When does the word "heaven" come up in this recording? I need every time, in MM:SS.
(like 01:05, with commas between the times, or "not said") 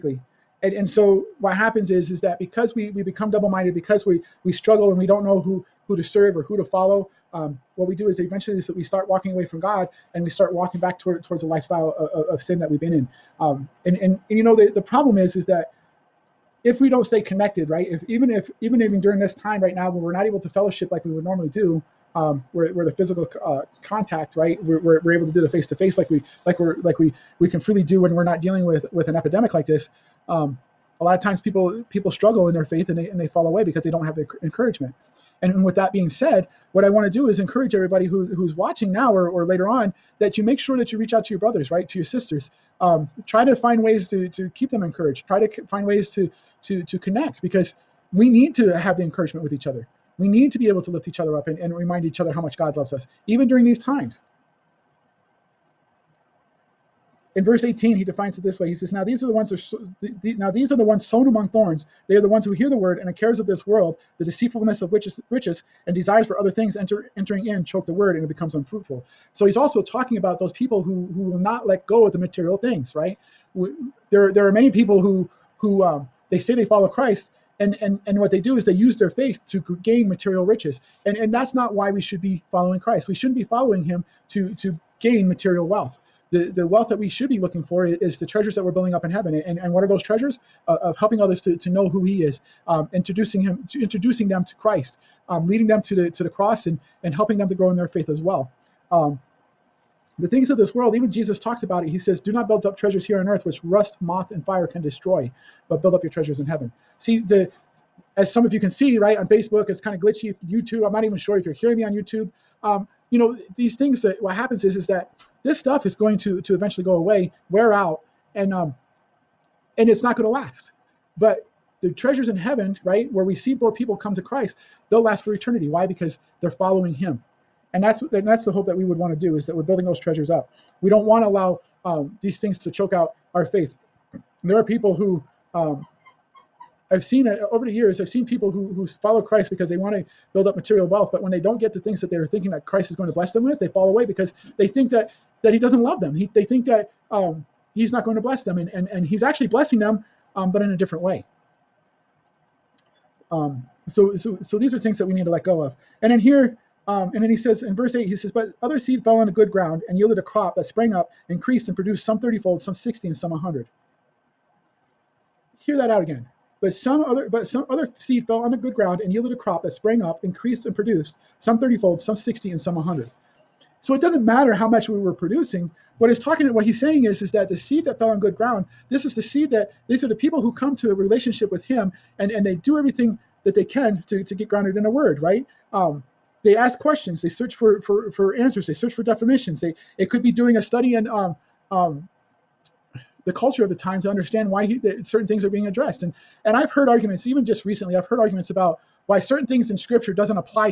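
01:29, 01:46, 02:02.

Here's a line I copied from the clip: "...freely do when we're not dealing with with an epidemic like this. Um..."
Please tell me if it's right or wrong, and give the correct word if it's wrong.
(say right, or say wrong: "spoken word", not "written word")
right.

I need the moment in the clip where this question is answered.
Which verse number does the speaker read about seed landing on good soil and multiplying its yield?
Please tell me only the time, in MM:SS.
02:37.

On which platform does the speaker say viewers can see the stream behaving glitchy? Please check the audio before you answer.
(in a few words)
Facebook.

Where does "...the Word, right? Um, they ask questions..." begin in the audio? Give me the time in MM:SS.
03:04.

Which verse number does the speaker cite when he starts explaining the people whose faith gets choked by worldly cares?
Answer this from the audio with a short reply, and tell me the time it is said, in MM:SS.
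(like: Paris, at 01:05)
18, at 00:57.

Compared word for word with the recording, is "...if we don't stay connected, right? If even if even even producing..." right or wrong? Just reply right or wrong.
wrong.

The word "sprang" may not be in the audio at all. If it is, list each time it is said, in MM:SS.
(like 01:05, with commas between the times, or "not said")
02:40, 02:49.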